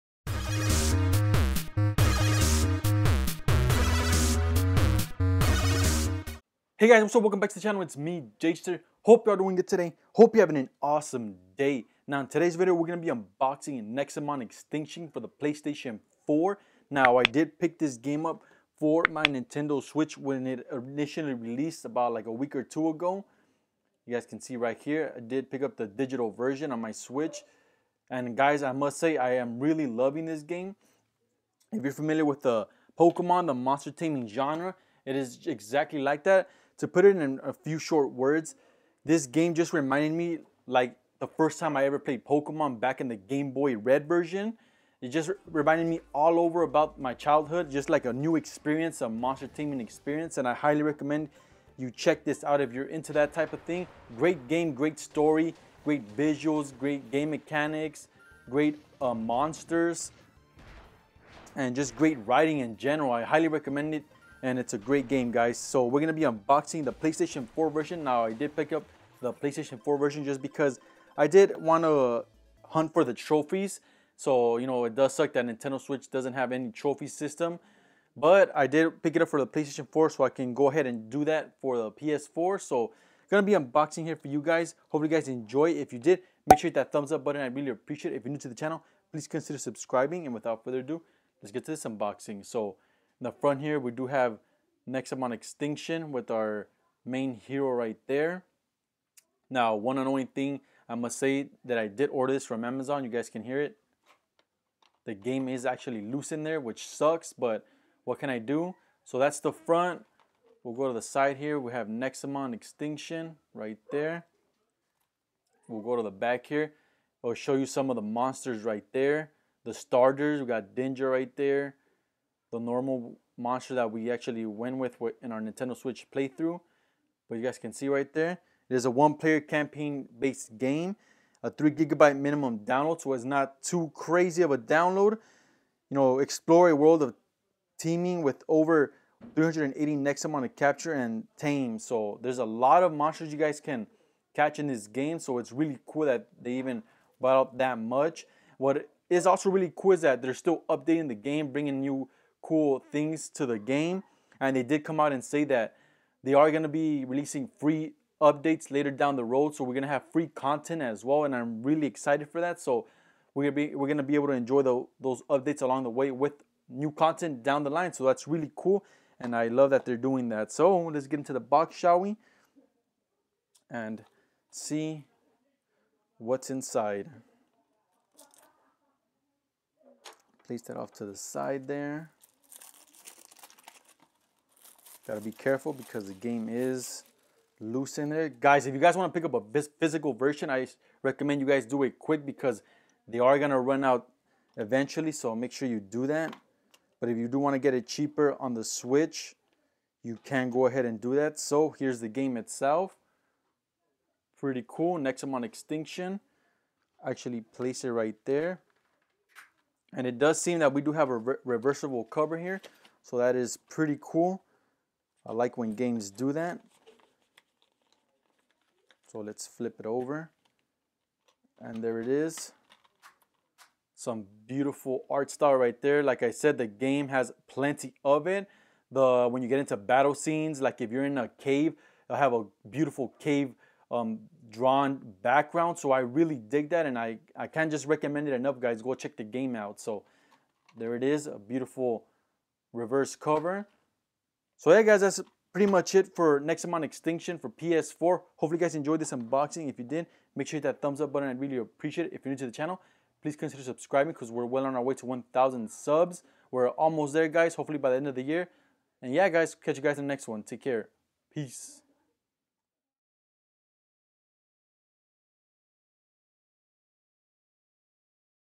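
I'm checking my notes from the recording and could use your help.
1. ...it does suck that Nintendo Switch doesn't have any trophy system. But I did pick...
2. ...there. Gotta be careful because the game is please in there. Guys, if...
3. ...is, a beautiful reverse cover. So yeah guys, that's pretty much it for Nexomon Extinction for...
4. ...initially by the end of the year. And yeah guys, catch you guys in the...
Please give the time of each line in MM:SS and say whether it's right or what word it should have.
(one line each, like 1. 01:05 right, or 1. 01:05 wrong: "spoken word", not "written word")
1. 01:14 right
2. 03:01 wrong: "loose", not "please"
3. 04:01 right
4. 04:17 wrong: "hopefully", not "initially".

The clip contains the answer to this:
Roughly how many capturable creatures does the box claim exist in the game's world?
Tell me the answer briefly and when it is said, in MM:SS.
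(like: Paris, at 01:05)
over 380, at 02:18.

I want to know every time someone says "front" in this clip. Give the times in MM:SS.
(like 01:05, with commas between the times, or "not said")
01:33, 01:49.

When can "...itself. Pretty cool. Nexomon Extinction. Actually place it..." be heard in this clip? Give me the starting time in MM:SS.
03:22.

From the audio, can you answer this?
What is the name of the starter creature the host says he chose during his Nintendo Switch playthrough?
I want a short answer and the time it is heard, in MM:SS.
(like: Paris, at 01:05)
Dinger, at 02:00.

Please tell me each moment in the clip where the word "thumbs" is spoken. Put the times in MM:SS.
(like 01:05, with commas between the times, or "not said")
01:26, 04:10.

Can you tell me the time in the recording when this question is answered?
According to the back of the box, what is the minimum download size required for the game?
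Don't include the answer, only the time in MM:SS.
02:11.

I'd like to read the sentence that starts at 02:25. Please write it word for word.
So it's really cool that they even brought up that much.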